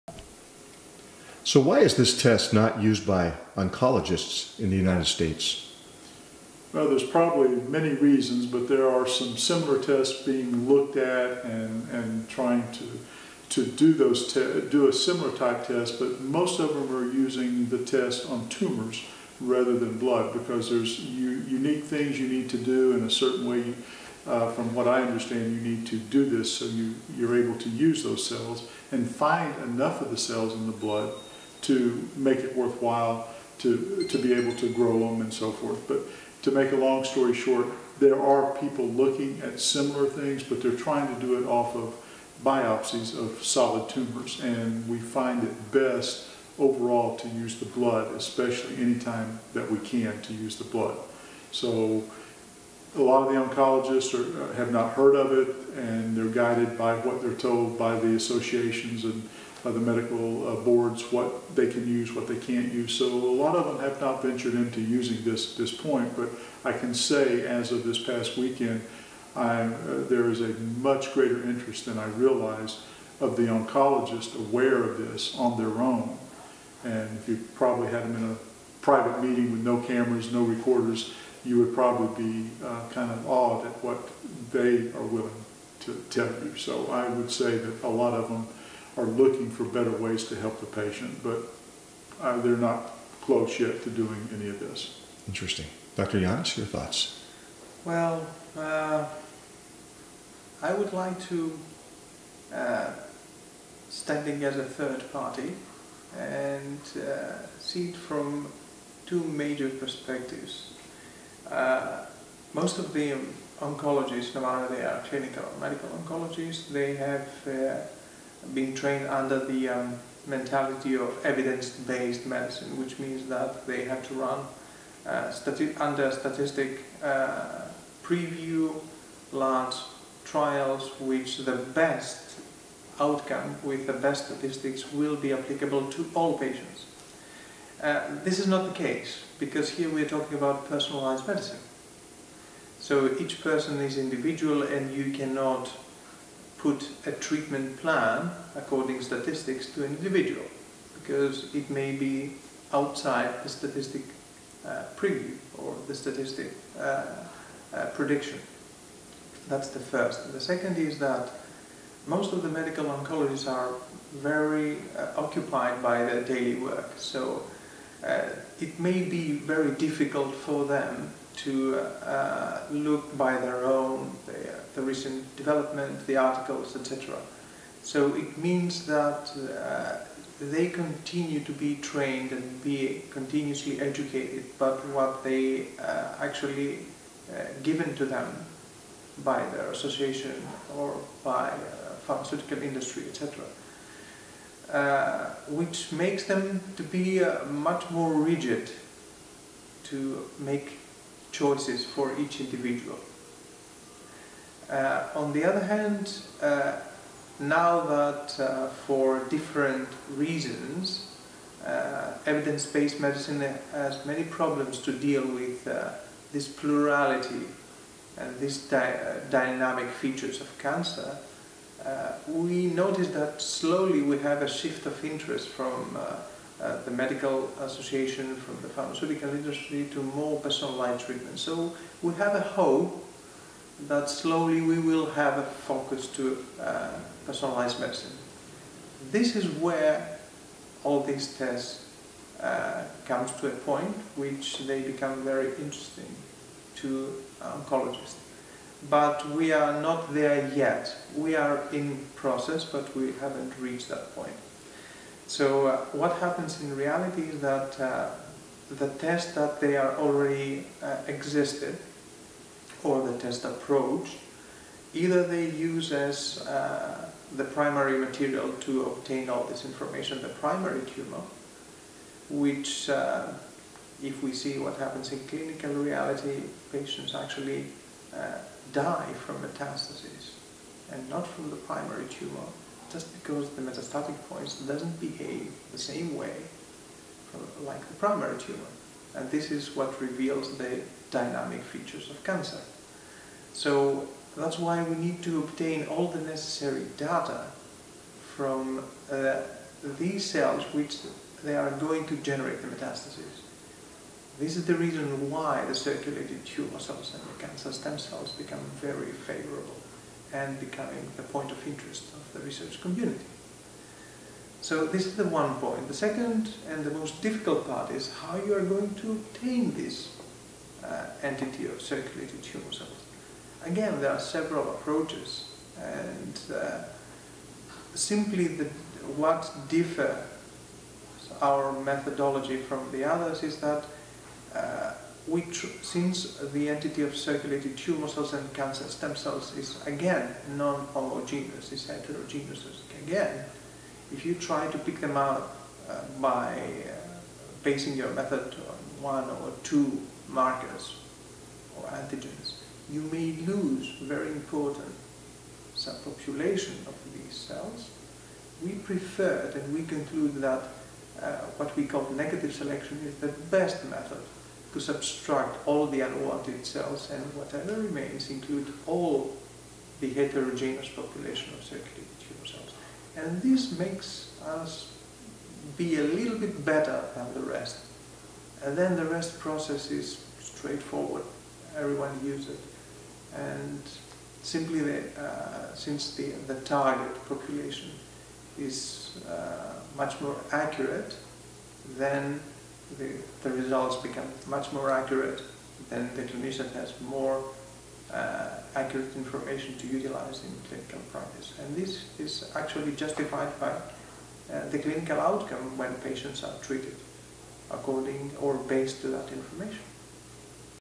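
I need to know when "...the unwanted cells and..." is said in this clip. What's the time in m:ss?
6:05.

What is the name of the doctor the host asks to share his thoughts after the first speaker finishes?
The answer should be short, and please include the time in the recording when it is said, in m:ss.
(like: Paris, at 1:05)
Dr. Giannis, at 1:35.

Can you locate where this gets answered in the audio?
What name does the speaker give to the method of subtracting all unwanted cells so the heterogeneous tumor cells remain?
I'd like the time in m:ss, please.
6:02.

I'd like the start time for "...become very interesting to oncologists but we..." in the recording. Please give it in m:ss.
4:04.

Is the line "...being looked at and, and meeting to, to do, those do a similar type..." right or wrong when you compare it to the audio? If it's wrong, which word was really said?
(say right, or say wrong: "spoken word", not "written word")
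wrong: "trying", not "meeting".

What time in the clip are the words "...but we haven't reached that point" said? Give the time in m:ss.
4:12.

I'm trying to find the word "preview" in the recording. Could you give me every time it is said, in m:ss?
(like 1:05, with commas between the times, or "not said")
2:08, 2:34.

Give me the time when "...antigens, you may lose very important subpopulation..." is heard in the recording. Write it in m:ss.
5:51.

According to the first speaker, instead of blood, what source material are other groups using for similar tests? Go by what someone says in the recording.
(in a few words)
Biopsies of solid tumors.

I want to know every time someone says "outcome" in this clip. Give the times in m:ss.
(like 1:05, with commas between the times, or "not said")
2:12, 6:45.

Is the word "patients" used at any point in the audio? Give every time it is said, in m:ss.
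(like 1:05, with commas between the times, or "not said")
1:30, 2:16, 4:36, 6:45.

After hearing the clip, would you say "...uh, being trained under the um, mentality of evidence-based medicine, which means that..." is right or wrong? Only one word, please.
right.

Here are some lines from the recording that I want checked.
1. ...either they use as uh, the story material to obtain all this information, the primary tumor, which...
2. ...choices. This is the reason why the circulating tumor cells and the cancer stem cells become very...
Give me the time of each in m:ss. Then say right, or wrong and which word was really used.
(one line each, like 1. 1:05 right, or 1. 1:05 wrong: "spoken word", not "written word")
1. 4:24 wrong: "primary", not "story"
2. 5:02 wrong: "metastases", not "choices".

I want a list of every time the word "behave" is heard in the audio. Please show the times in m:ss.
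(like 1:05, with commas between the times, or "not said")
4:44.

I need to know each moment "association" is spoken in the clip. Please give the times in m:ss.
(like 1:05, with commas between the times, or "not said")
0:58, 3:09, 3:47.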